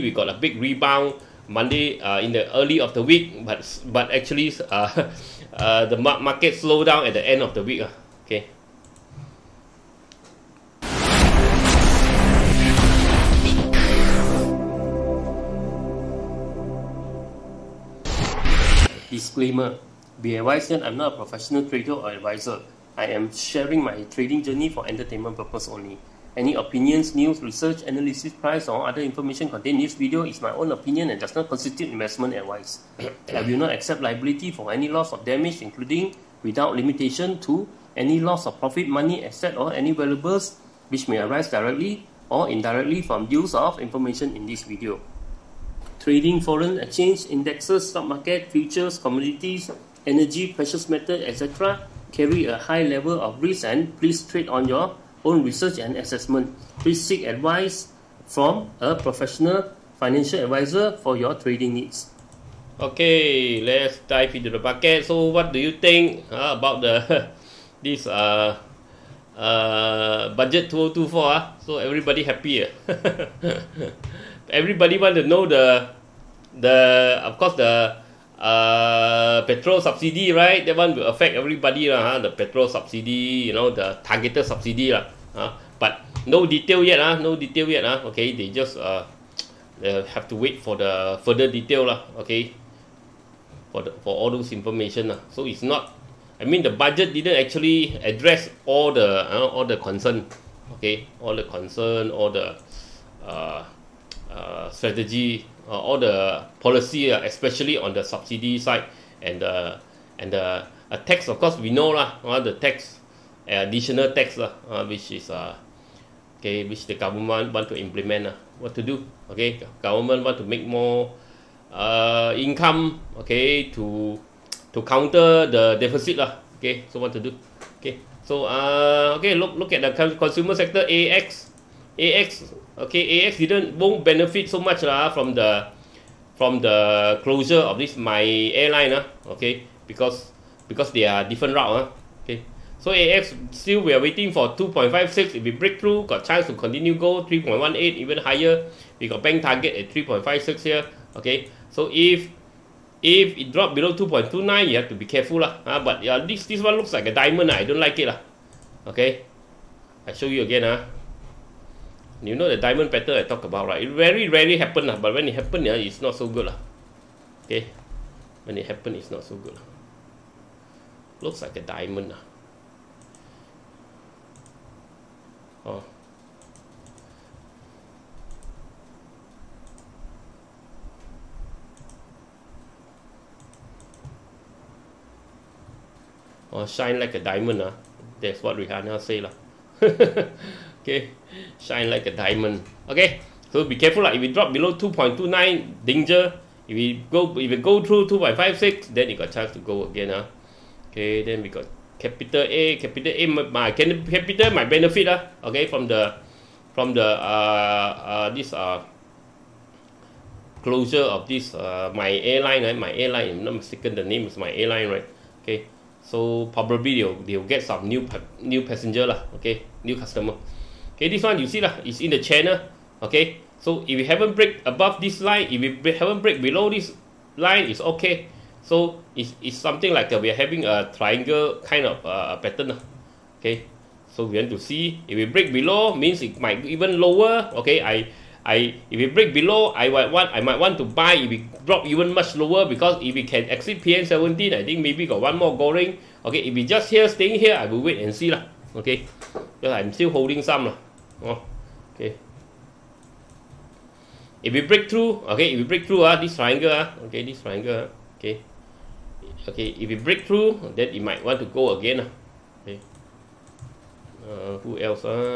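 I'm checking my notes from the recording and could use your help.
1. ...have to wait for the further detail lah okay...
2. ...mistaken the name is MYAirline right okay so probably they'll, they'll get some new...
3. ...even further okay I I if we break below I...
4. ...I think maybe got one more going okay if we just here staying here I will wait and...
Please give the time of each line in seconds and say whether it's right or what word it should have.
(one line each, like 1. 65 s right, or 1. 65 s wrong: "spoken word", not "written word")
1. 90 s right
2. 213 s right
3. 236 s wrong: "lower", not "further"
4. 244 s right.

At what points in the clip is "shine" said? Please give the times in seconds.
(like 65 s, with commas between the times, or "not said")
186 s, 191 s.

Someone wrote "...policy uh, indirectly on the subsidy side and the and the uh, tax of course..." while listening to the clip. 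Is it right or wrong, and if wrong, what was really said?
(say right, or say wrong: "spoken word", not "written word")
wrong: "especially", not "indirectly".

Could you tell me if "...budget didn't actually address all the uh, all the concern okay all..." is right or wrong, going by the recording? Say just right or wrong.
right.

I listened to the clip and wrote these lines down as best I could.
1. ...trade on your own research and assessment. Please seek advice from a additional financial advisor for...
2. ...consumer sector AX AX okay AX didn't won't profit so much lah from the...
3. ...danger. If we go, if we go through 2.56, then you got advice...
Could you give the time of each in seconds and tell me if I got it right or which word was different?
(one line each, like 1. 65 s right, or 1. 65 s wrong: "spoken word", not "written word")
1. 54 s wrong: "professional", not "additional"
2. 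130 s wrong: "benefit", not "profit"
3. 195 s wrong: "chance", not "advice".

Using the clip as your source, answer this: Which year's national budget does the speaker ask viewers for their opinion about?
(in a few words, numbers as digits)
2024.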